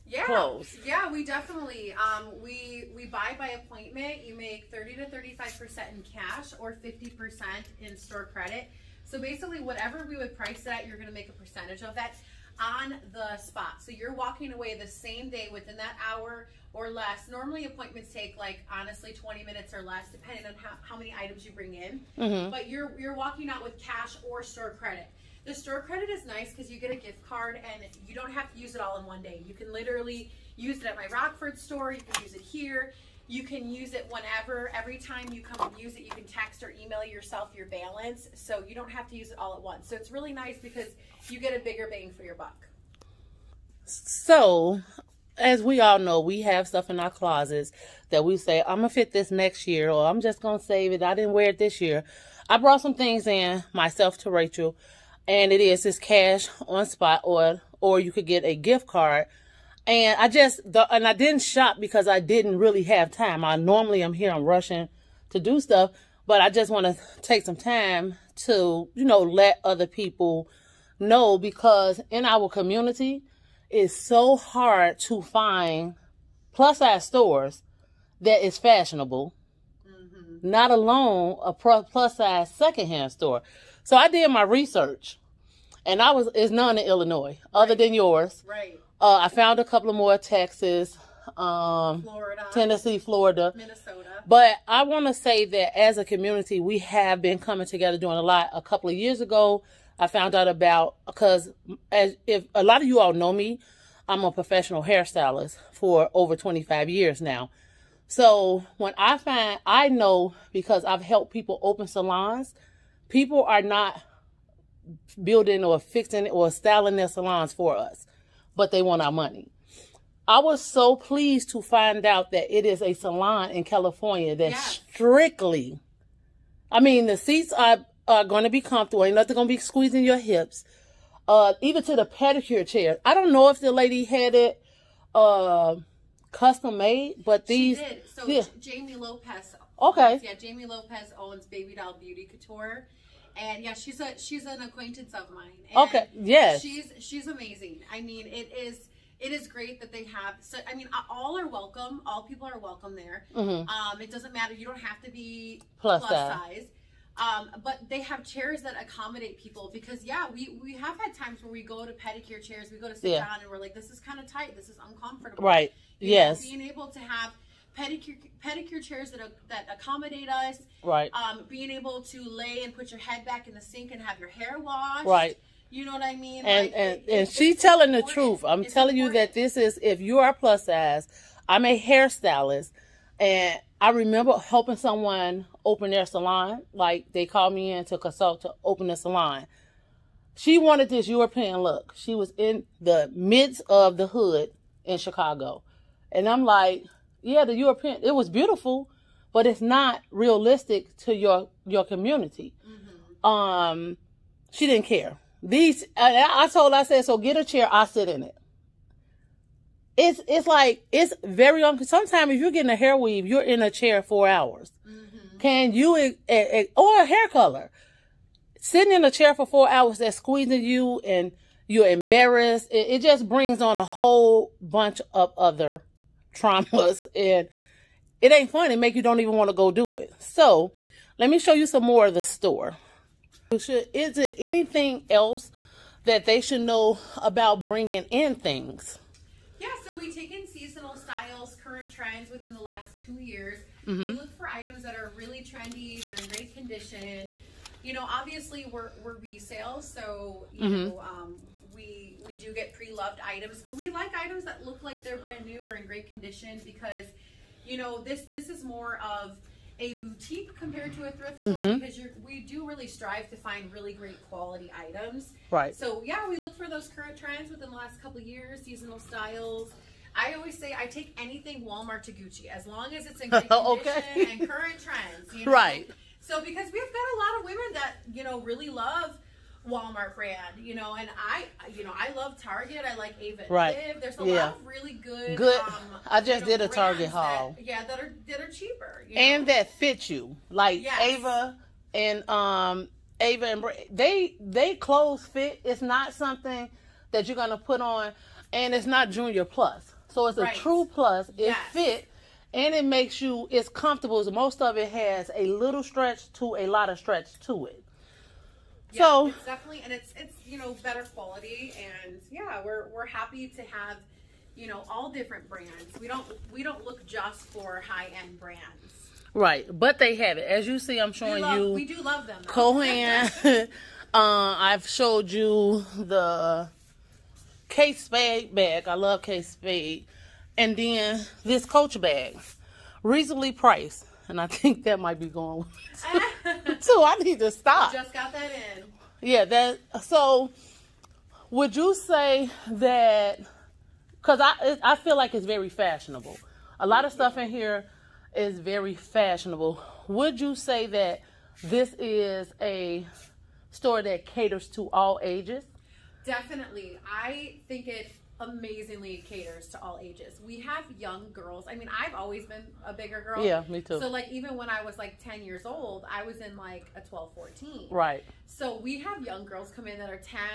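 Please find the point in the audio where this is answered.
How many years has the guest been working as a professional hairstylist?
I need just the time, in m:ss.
1:46.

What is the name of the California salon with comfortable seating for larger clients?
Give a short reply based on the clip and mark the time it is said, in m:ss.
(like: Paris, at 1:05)
Baby Doll Beauty Couture, at 2:21.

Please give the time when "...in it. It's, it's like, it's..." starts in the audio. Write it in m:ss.
3:28.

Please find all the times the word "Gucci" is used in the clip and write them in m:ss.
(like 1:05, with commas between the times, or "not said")
4:32.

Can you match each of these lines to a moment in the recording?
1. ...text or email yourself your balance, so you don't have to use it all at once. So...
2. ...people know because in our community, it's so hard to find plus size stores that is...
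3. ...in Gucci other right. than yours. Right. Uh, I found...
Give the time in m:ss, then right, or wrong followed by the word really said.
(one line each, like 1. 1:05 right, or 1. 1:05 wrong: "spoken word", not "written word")
1. 0:36 right
2. 1:09 right
3. 1:26 wrong: "Illinois", not "Gucci".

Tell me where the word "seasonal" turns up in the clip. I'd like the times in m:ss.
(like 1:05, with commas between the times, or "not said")
4:00, 4:28.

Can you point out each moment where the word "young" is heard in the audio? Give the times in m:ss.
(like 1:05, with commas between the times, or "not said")
6:00, 6:09.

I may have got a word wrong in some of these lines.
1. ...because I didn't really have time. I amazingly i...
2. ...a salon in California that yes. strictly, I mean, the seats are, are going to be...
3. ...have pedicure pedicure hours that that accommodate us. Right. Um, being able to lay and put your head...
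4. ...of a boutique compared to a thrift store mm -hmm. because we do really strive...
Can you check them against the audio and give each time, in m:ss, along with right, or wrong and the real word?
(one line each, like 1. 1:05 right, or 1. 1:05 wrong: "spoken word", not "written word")
1. 1:01 wrong: "normally", not "amazingly"
2. 2:02 right
3. 2:46 wrong: "chairs", not "hours"
4. 4:19 right.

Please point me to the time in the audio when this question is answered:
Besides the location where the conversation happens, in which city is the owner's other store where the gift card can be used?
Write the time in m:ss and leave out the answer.
0:31.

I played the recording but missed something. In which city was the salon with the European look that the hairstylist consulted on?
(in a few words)
Chicago.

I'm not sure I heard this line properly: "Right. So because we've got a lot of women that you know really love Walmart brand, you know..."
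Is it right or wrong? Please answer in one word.
right.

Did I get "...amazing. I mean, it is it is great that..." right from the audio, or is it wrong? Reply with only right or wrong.
right.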